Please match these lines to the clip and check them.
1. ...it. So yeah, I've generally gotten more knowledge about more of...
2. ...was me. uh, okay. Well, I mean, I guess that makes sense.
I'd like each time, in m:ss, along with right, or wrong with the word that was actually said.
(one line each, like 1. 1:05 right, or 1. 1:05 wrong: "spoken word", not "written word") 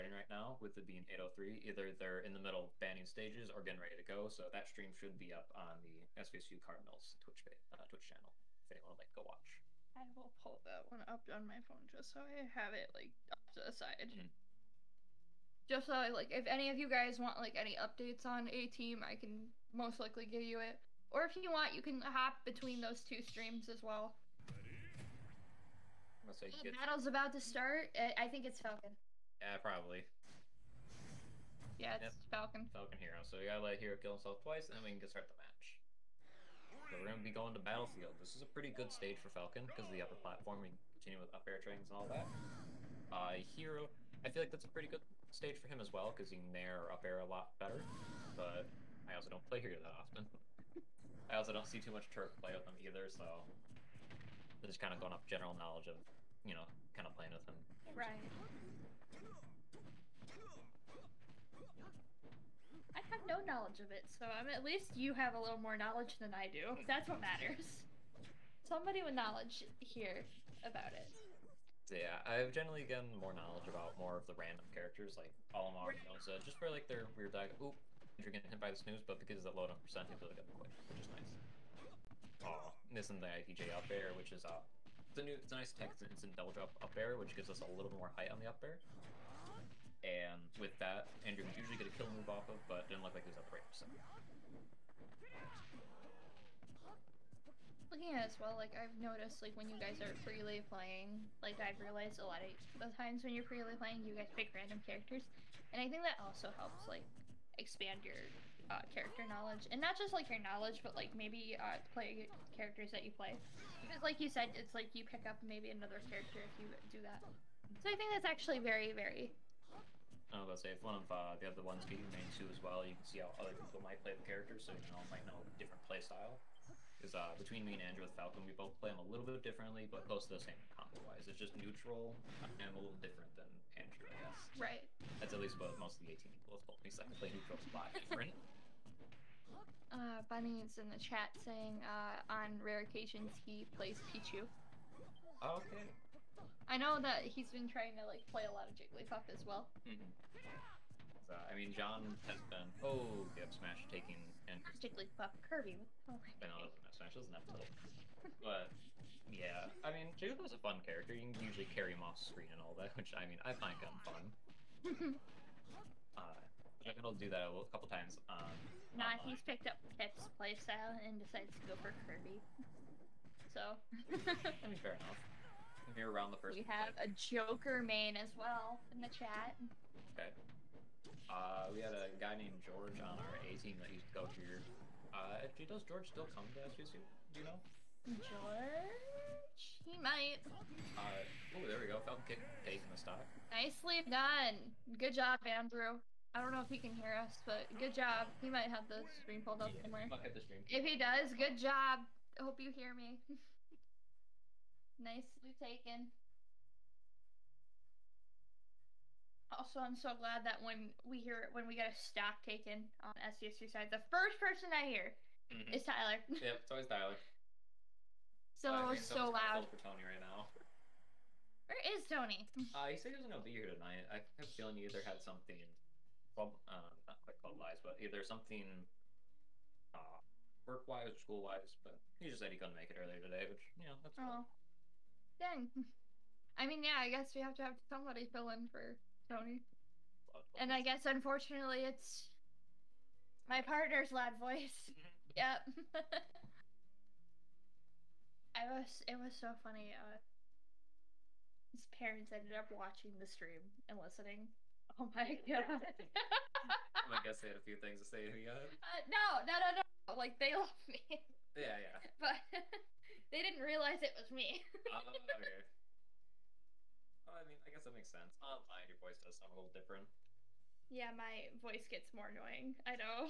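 1. 1:10 right
2. 4:24 right.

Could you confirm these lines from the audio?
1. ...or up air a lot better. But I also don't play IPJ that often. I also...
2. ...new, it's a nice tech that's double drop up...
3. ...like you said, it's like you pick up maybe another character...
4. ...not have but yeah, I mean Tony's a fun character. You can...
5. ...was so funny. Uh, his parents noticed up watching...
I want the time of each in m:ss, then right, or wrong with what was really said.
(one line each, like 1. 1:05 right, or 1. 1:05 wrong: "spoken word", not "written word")
1. 0:46 wrong: "Hero", not "IPJ"
2. 1:25 right
3. 1:54 right
4. 2:37 wrong: "Jigglypuff", not "Tony"
5. 4:09 wrong: "ended", not "noticed".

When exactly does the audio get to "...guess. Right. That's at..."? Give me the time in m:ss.
2:14.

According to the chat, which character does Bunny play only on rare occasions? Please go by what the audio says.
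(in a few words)
Pichu.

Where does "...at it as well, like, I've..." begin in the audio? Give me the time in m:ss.
1:38.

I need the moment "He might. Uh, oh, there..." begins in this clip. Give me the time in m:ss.
3:09.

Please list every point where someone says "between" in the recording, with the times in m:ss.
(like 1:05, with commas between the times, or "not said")
0:22, 2:07.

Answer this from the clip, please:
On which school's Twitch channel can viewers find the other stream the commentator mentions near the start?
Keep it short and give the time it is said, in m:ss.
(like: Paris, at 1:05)
SVSU Cardinals, at 0:06.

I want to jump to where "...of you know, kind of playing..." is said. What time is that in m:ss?
0:55.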